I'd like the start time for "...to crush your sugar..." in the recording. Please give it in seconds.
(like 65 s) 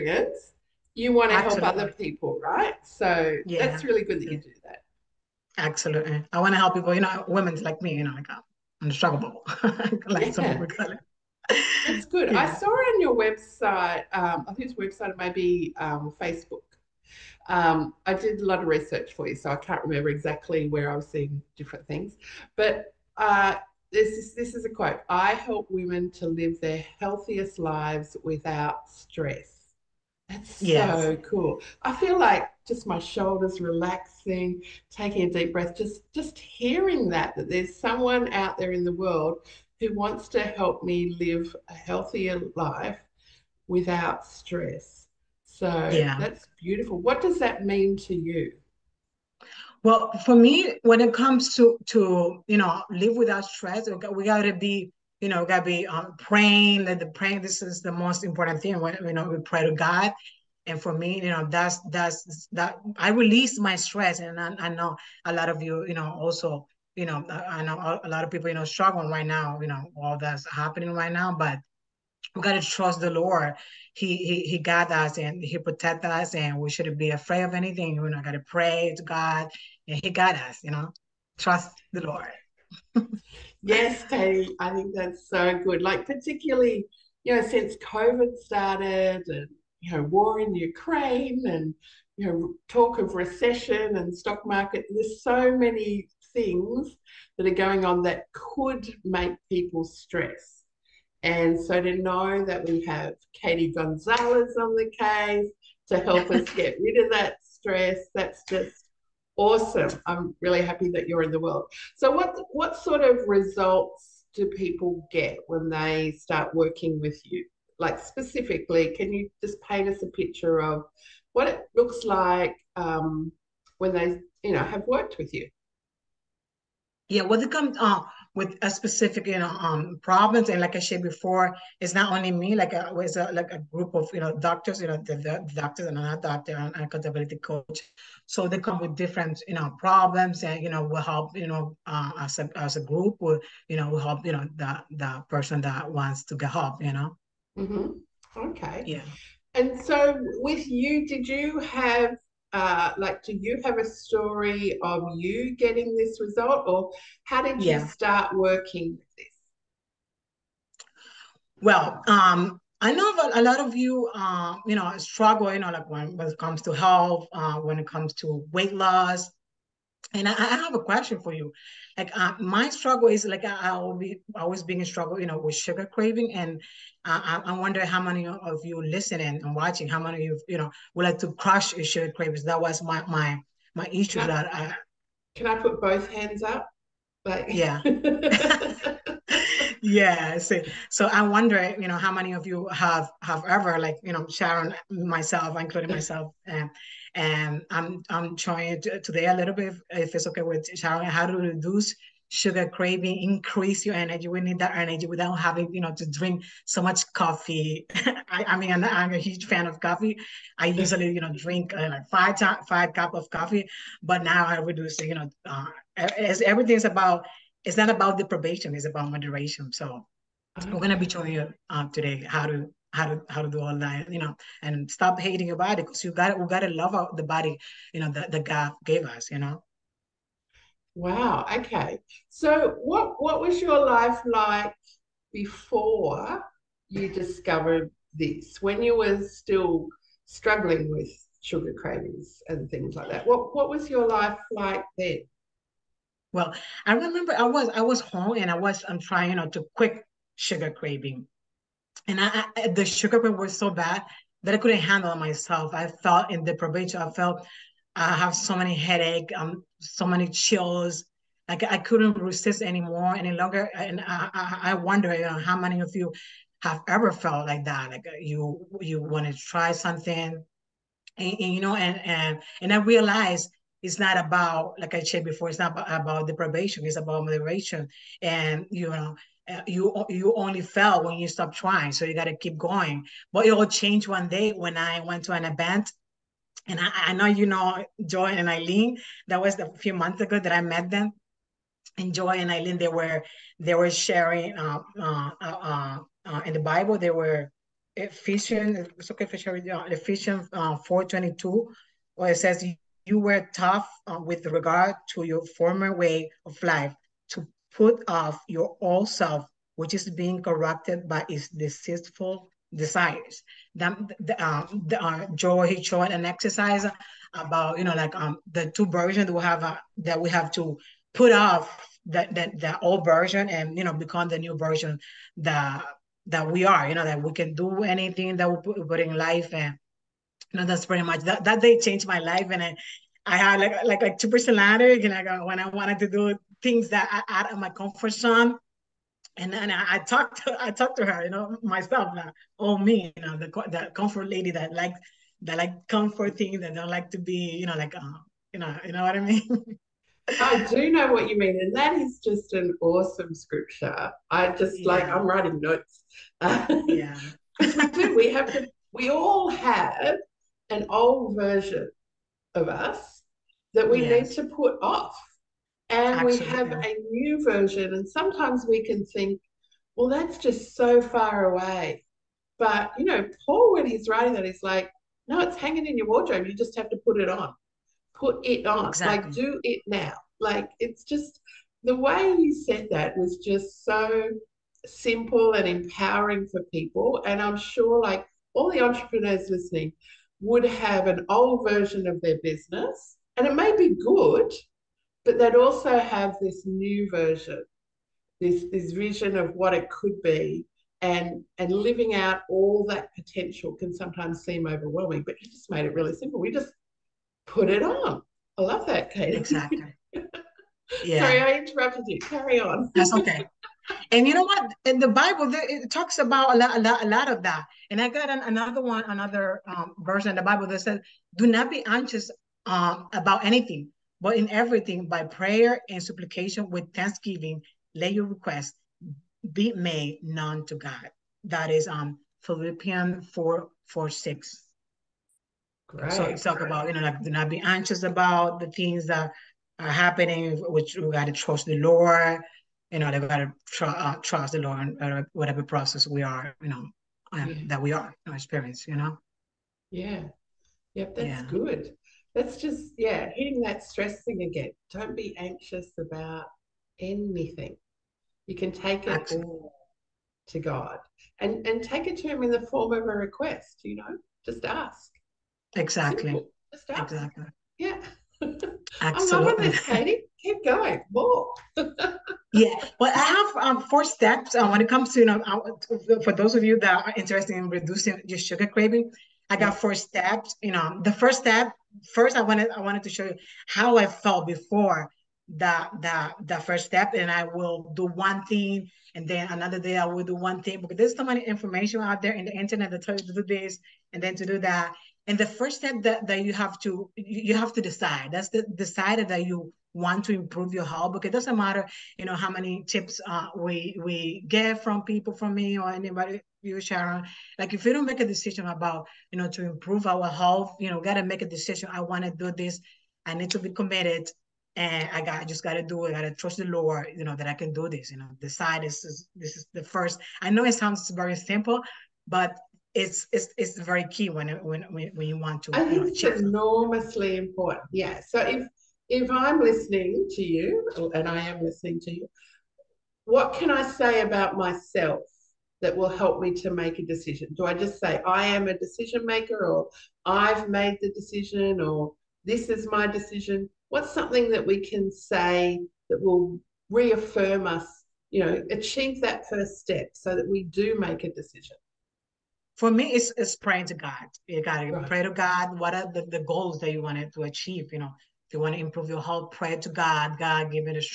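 181 s.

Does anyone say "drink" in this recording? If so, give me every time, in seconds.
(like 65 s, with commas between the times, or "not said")
206 s, 211 s.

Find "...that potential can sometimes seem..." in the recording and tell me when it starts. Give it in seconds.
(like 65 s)
402 s.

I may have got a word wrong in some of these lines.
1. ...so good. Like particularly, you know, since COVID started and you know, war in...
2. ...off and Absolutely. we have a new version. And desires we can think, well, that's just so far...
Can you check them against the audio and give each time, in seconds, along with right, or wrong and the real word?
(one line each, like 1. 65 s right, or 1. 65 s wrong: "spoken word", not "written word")
1. 85 s right
2. 364 s wrong: "sometimes", not "desires".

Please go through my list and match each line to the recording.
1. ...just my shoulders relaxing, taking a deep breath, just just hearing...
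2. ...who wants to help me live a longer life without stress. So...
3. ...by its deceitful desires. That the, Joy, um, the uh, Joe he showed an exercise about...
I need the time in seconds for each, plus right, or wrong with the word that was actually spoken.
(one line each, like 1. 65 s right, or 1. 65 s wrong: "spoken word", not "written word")
1. 32 s right
2. 39 s wrong: "healthier", not "longer"
3. 311 s right.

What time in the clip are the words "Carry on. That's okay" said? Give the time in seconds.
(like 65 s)
412 s.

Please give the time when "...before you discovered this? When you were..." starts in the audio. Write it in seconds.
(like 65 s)
235 s.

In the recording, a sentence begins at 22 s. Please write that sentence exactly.
But uh, this, is, this is a quote I help women to live their healthiest lives without stress.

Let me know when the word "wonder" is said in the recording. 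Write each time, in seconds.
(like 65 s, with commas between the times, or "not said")
177 s, 191 s, 264 s.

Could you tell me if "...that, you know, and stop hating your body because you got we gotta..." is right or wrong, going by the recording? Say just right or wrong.
right.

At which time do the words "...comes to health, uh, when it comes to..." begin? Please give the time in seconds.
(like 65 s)
166 s.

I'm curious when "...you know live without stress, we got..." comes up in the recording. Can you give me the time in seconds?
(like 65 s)
52 s.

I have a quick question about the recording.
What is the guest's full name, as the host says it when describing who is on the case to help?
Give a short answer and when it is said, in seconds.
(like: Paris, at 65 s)
Katy Gonzalez, at 103 s.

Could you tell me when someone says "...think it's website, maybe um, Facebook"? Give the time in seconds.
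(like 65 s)
14 s.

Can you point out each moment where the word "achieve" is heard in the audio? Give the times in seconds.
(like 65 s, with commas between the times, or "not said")
548 s, 557 s.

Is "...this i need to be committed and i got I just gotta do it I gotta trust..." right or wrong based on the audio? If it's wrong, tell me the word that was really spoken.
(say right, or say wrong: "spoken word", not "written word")
right.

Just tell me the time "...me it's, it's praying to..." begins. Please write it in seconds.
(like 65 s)
552 s.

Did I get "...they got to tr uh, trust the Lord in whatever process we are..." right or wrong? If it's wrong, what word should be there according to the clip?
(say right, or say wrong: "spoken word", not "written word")
right.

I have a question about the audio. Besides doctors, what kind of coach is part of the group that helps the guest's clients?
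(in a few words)
accountability coach.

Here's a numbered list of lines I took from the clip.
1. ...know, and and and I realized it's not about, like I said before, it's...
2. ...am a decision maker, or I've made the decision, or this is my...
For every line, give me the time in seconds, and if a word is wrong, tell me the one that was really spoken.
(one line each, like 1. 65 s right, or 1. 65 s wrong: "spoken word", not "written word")
1. 271 s right
2. 538 s right.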